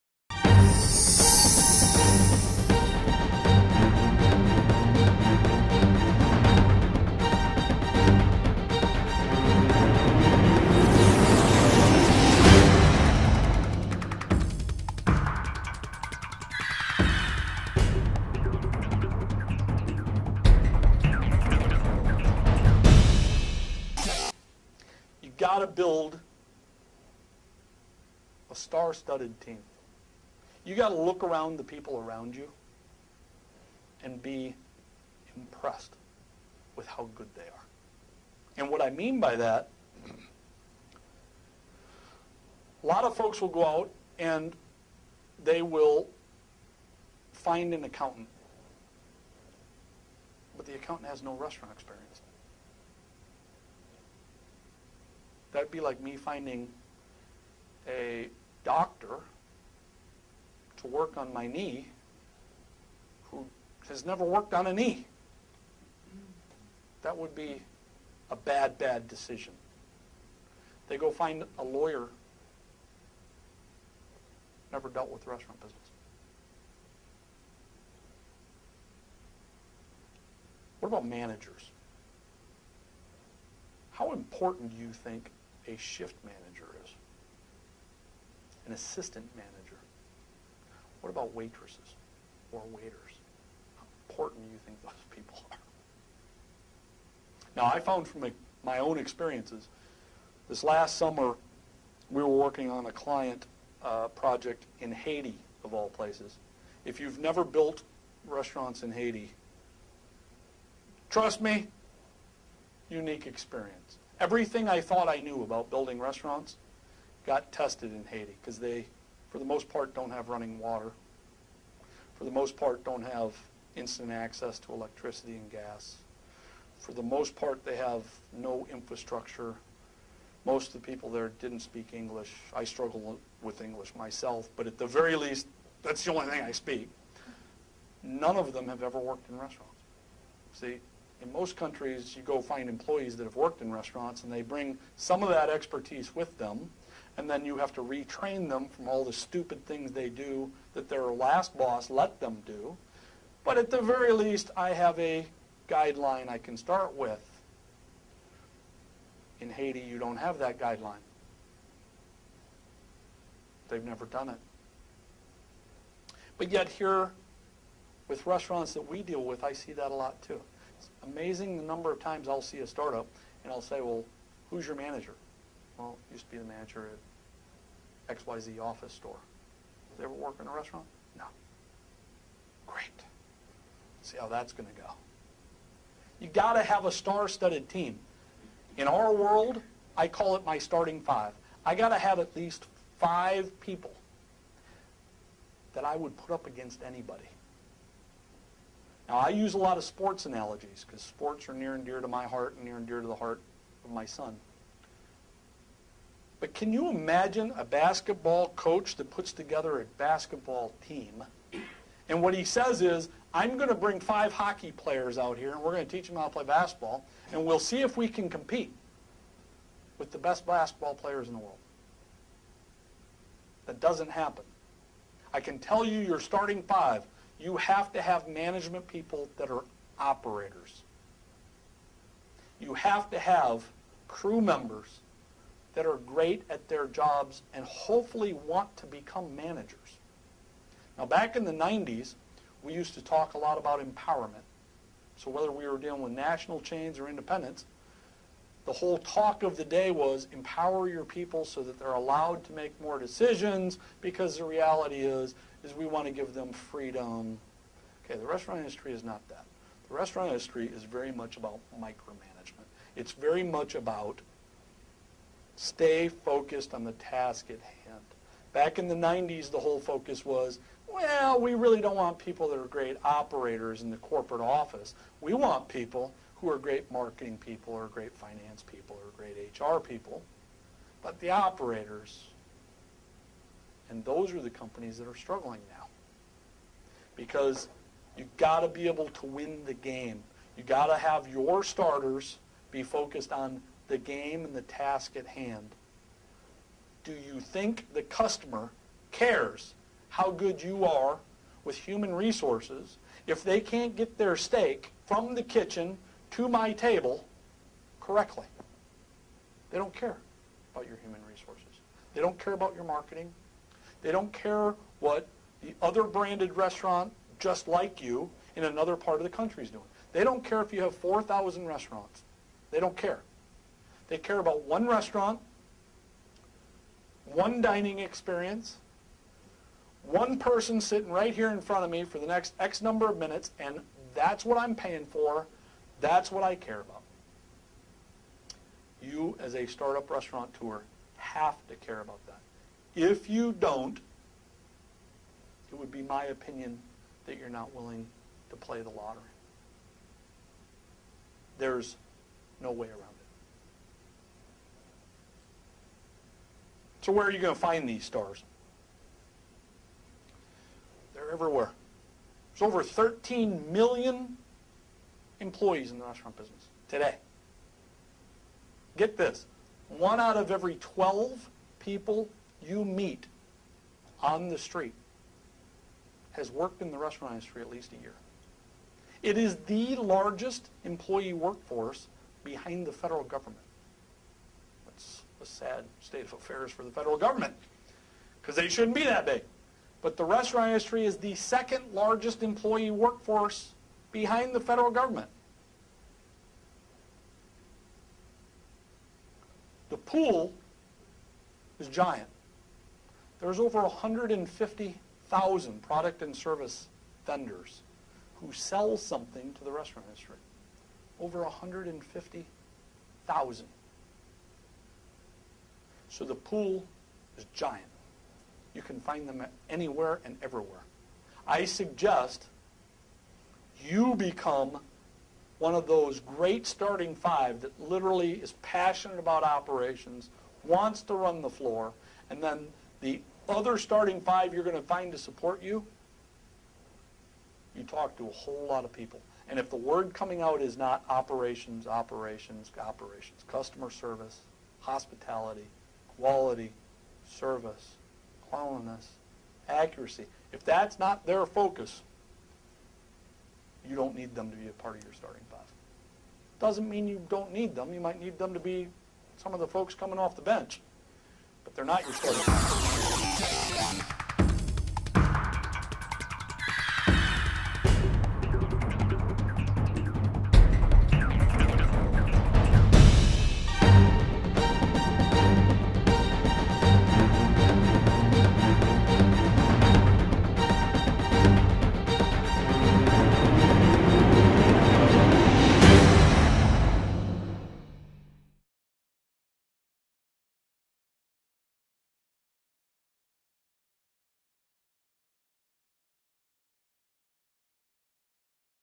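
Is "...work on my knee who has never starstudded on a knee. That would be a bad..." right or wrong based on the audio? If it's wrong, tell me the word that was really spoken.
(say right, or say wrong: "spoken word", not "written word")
wrong: "worked", not "starstudded".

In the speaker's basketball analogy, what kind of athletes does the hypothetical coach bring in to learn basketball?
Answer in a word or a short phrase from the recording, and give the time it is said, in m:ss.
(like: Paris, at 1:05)
Hockey players, at 3:34.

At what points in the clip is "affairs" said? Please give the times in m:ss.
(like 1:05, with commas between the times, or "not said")
6:26.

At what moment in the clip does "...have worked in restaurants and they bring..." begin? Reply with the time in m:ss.
2:23.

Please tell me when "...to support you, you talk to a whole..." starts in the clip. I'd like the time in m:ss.
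7:15.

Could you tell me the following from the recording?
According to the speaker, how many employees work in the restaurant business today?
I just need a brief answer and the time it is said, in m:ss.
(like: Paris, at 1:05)
Over 13 million, at 6:02.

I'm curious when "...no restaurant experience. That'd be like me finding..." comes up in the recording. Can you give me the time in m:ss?
0:51.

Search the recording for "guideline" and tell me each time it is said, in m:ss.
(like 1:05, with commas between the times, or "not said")
2:35, 2:40.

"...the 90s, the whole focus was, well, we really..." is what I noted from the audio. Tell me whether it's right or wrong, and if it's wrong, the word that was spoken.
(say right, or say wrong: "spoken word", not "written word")
right.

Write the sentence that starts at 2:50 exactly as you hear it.
It's amazing the number of times I'll see a startup and I'll say, well, who's your manager?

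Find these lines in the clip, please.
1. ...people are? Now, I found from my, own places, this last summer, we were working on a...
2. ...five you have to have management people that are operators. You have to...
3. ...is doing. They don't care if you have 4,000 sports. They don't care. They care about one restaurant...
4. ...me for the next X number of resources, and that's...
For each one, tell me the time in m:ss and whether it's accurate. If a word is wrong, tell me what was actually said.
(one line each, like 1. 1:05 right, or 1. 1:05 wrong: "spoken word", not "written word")
1. 1:35 wrong: "experiences", not "places"
2. 3:46 right
3. 5:19 wrong: "restaurants", not "sports"
4. 5:31 wrong: "minutes", not "resources".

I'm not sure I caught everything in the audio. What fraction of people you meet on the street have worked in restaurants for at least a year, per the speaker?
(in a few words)
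1 out of 12.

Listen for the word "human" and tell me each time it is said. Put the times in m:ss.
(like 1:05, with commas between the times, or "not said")
5:01, 5:11.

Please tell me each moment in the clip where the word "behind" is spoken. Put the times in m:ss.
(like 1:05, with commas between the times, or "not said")
6:22, 6:34.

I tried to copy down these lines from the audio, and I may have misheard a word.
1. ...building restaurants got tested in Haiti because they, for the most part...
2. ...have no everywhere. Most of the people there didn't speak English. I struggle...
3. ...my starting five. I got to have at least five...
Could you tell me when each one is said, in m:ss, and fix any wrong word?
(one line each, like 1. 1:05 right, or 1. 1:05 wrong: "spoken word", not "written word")
1. 1:55 right
2. 2:07 wrong: "infrastructure", not "everywhere"
3. 3:10 right.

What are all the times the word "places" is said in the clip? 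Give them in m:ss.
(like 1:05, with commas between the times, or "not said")
1:45.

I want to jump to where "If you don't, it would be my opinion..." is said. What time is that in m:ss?
5:42.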